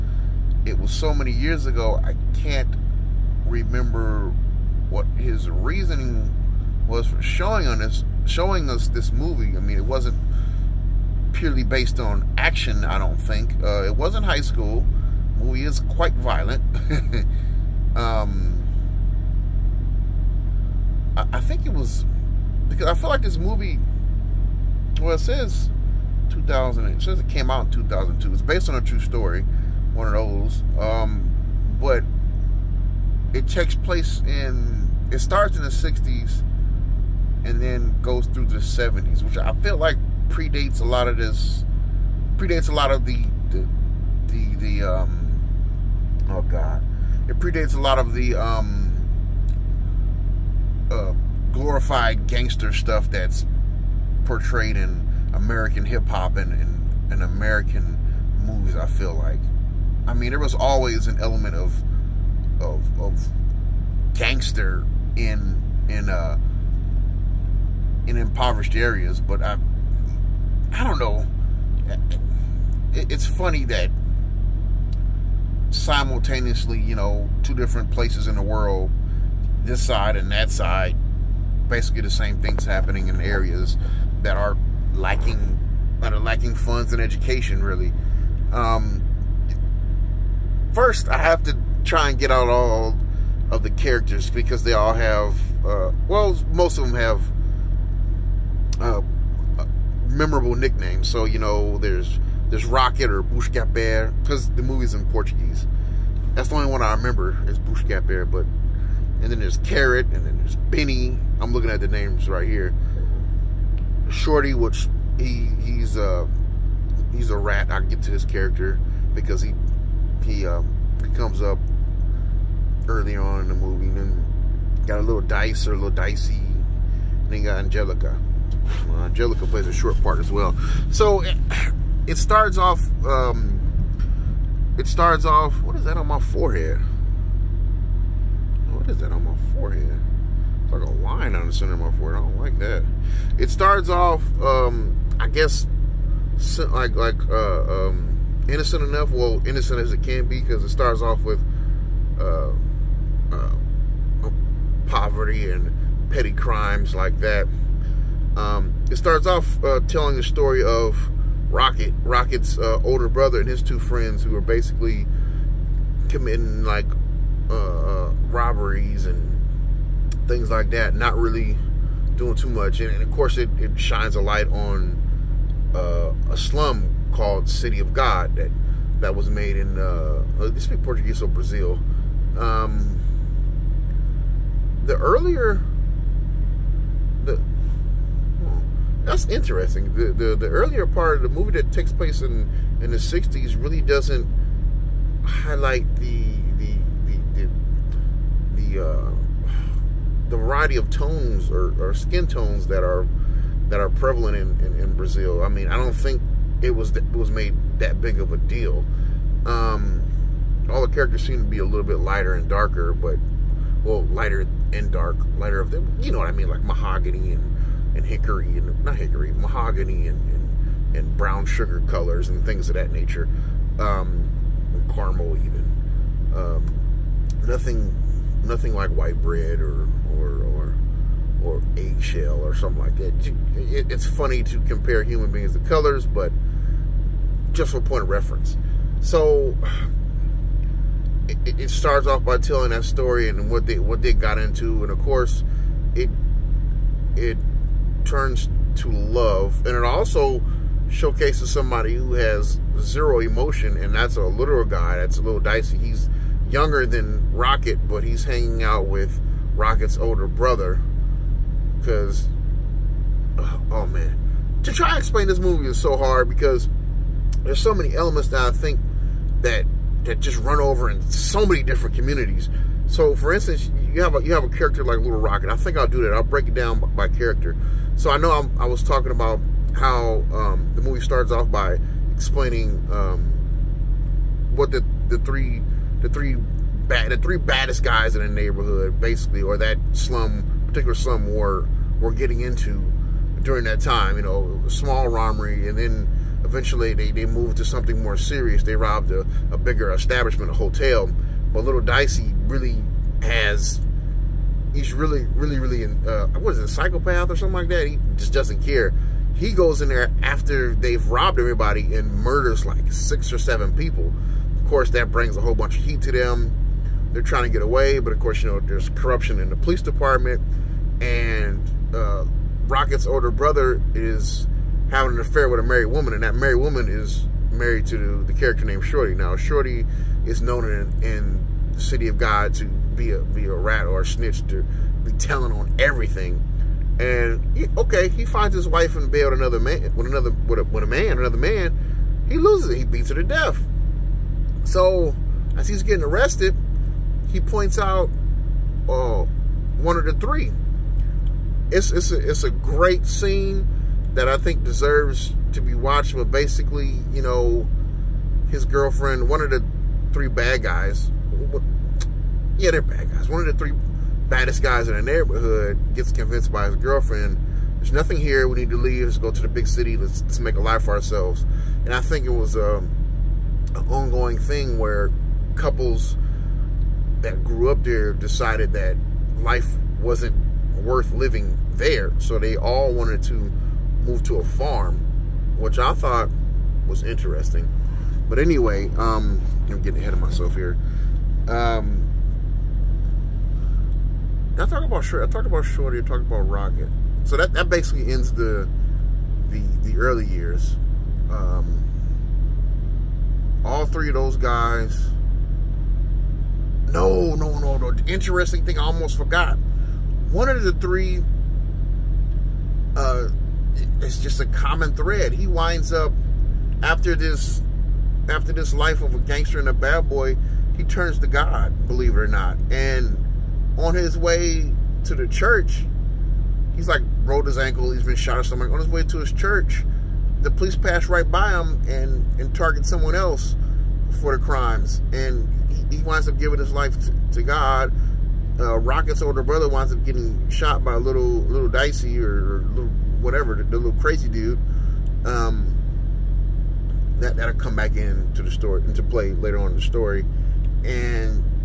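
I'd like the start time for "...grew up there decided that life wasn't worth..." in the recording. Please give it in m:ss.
6:17.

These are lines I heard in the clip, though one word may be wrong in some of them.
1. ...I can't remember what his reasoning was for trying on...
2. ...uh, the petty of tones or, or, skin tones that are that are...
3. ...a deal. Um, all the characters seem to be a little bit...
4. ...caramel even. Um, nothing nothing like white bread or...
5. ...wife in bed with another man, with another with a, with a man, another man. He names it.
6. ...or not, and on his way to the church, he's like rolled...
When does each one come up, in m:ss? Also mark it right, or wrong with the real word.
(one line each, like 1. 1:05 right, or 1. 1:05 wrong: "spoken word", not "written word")
1. 0:02 wrong: "showing", not "trying"
2. 3:18 wrong: "variety", not "petty"
3. 3:28 right
4. 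3:44 right
5. 5:38 wrong: "loses", not "names"
6. 7:02 right.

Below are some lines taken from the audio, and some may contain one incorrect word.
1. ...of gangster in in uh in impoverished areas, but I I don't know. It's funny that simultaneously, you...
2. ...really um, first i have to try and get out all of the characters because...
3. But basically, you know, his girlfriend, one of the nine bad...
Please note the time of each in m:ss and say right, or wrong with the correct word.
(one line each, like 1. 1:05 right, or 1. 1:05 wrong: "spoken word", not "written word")
1. 1:02 right
2. 1:27 right
3. 5:56 wrong: "three", not "nine".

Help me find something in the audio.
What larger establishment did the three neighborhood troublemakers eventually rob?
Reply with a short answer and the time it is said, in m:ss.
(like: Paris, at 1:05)
A hotel, at 5:00.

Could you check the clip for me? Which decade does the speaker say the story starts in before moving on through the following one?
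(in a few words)
The 60s.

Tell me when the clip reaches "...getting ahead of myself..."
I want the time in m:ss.
6:29.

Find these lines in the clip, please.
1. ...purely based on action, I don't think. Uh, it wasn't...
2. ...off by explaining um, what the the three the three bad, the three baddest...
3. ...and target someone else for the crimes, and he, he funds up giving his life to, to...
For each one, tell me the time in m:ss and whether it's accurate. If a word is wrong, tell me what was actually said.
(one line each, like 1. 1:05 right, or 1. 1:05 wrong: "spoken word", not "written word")
1. 0:11 right
2. 4:41 right
3. 7:12 wrong: "winds", not "funds".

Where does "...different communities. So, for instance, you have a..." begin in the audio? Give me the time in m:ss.
4:31.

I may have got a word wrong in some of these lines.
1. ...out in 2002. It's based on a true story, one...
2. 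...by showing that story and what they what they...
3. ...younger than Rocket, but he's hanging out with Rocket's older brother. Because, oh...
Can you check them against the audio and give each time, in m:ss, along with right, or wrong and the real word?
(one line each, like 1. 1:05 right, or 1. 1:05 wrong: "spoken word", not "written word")
1. 0:27 right
2. 4:02 wrong: "telling", not "showing"
3. 4:16 right.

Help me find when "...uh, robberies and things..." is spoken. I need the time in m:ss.
2:48.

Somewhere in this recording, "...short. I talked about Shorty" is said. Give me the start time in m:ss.
6:35.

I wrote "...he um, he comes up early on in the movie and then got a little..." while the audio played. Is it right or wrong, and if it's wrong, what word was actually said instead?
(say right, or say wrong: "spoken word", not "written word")
right.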